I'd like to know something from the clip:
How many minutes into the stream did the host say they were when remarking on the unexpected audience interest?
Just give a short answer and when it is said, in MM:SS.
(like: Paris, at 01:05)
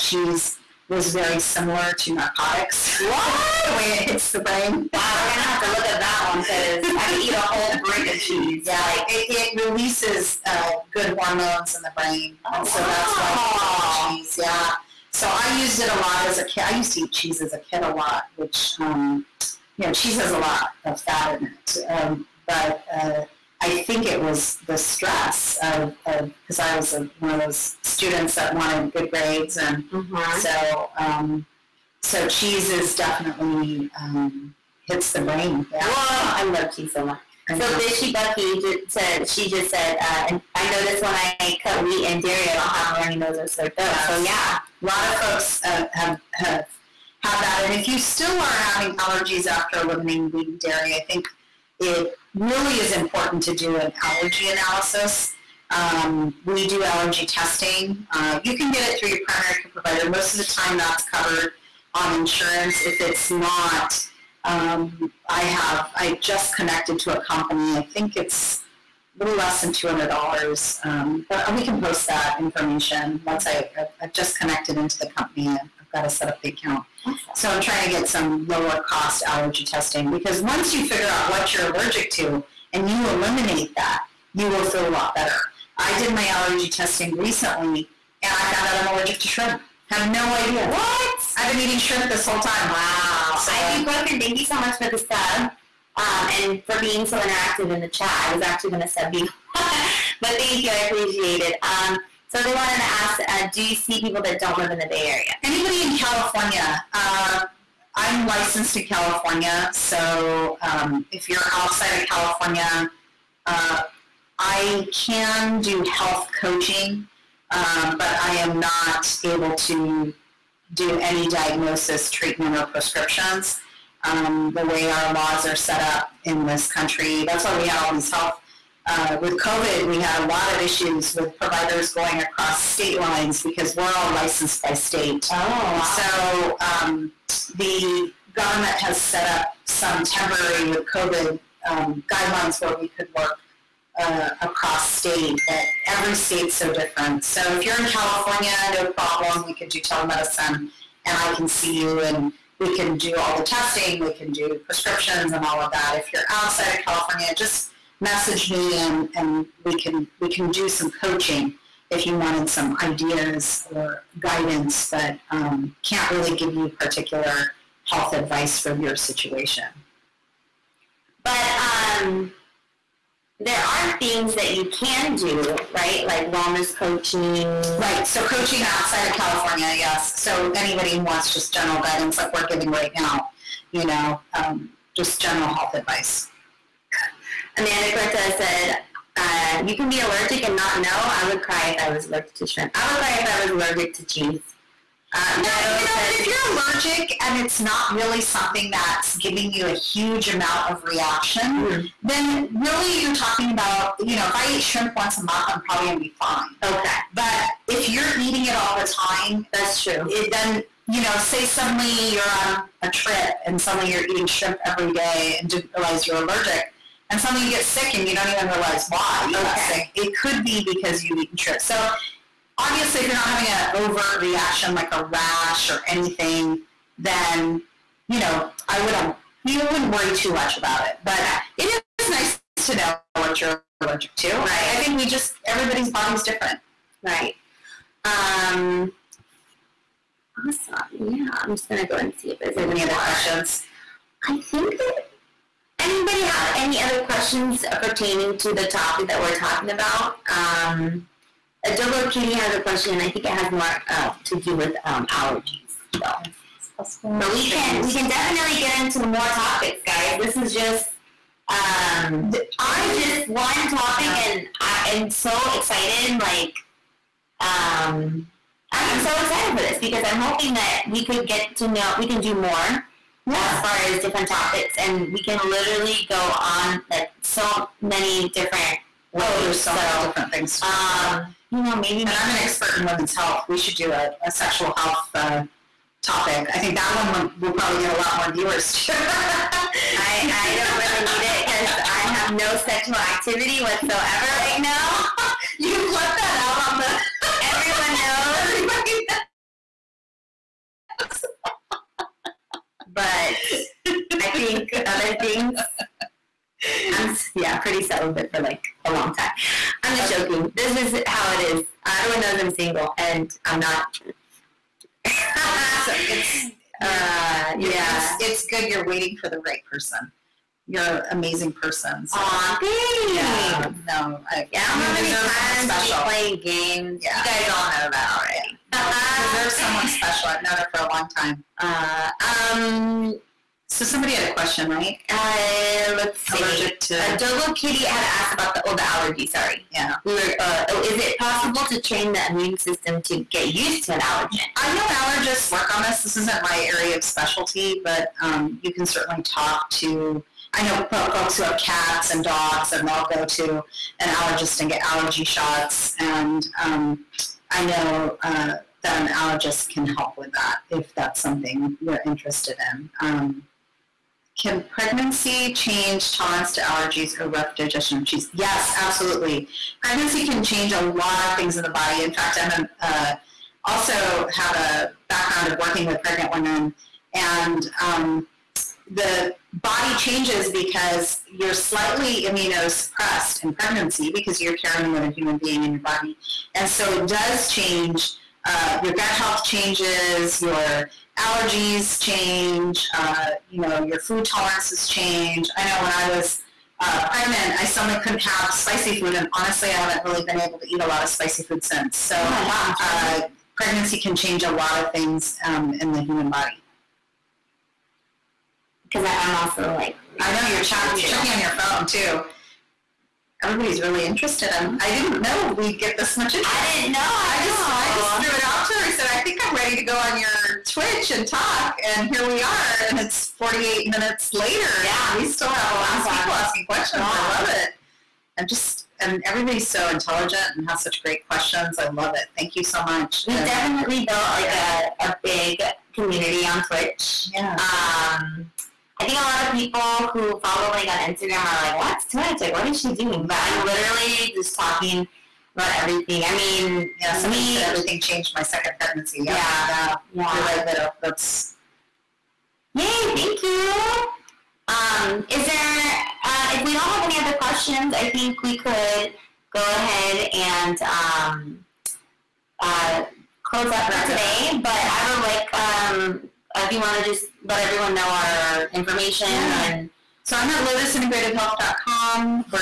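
48, at 07:03.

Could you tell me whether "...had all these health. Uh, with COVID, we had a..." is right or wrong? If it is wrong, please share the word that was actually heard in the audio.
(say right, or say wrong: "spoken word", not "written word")
right.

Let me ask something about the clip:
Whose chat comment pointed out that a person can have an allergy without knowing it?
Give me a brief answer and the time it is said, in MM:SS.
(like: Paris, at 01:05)
Amanda Cortez, at 03:07.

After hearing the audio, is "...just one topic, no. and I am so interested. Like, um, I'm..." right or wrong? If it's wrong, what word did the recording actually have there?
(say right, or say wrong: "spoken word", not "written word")
wrong: "excited", not "interested".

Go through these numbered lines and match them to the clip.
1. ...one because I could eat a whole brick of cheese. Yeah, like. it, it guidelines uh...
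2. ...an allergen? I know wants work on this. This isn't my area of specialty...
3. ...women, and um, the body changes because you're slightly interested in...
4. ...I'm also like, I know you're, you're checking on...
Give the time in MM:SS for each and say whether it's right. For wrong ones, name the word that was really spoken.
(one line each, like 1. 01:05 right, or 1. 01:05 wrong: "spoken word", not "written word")
1. 00:06 wrong: "releases", not "guidelines"
2. 05:43 wrong: "allergists", not "wants"
3. 06:16 wrong: "immunosuppressed", not "interested"
4. 06:49 right.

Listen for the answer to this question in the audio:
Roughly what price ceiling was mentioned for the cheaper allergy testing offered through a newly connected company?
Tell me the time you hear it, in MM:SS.
01:09.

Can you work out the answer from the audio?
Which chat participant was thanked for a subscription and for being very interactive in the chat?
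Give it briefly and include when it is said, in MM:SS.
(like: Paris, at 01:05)
Ibuprofen, at 01:33.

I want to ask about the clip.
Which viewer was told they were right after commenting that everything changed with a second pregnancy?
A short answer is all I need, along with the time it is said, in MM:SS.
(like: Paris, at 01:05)
Vito, at 07:30.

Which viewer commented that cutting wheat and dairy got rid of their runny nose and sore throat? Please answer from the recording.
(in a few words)
Bishy Bucky.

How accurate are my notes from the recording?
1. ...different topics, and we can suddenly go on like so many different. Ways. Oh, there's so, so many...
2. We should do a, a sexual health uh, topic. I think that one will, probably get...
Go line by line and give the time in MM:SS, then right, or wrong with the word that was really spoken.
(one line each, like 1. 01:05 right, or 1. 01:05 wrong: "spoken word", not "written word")
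1. 04:34 wrong: "literally", not "suddenly"
2. 04:43 right.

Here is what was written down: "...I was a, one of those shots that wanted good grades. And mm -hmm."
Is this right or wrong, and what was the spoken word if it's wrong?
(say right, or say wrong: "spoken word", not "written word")
wrong: "students", not "shots".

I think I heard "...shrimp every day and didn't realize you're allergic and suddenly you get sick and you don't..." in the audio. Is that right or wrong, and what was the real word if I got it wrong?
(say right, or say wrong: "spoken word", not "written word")
right.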